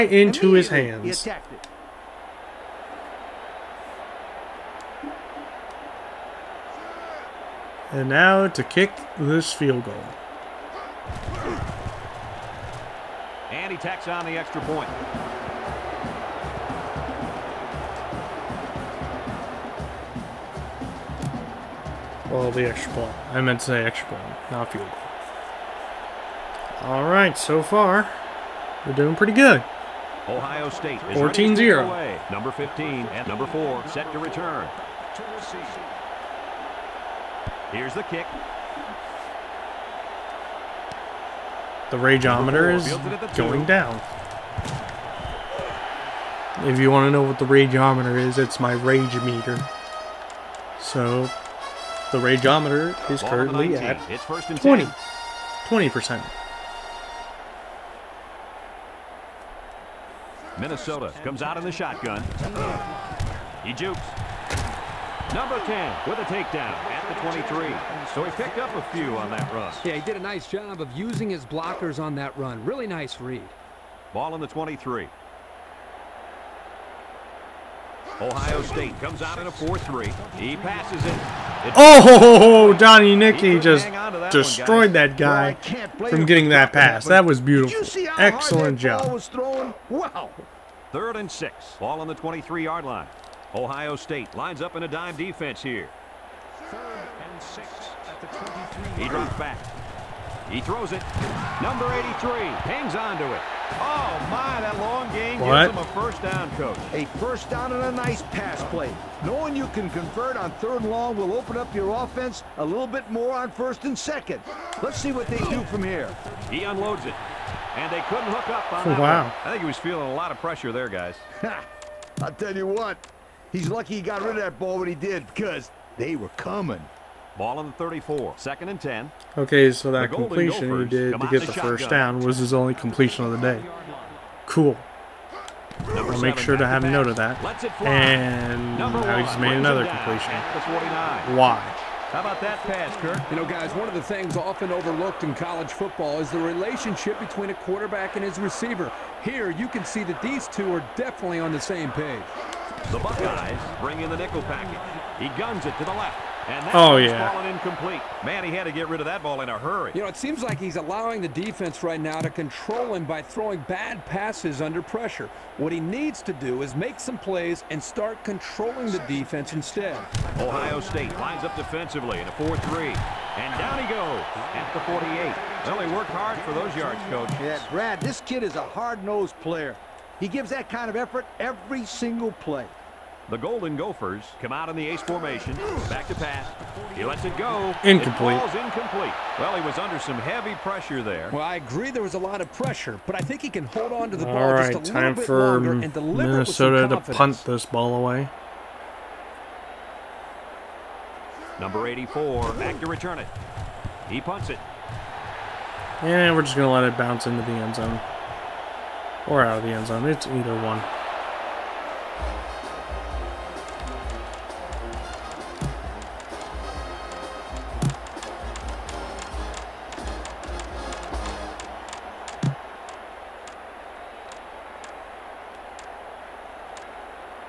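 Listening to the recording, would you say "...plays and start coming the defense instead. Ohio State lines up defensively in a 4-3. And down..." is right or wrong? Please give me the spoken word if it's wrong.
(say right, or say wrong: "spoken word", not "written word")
wrong: "controlling", not "coming".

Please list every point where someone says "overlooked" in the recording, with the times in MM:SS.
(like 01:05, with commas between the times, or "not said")
02:24.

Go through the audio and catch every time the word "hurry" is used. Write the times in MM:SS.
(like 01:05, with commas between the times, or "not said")
02:39.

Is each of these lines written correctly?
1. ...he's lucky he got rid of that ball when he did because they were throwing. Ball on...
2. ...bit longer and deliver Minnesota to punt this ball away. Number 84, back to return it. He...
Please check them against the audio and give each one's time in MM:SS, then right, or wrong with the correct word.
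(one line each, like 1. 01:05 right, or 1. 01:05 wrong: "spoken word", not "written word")
1. 02:03 wrong: "coming", not "throwing"
2. 03:15 right.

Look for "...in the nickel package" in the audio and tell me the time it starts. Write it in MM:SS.
02:33.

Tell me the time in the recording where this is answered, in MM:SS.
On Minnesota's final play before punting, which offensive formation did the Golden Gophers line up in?
03:04.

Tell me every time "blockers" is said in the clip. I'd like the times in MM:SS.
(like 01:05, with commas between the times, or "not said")
01:11.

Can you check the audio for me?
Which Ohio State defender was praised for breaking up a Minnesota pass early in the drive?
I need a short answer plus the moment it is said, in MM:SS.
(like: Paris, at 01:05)
Donnie Nickey, at 01:22.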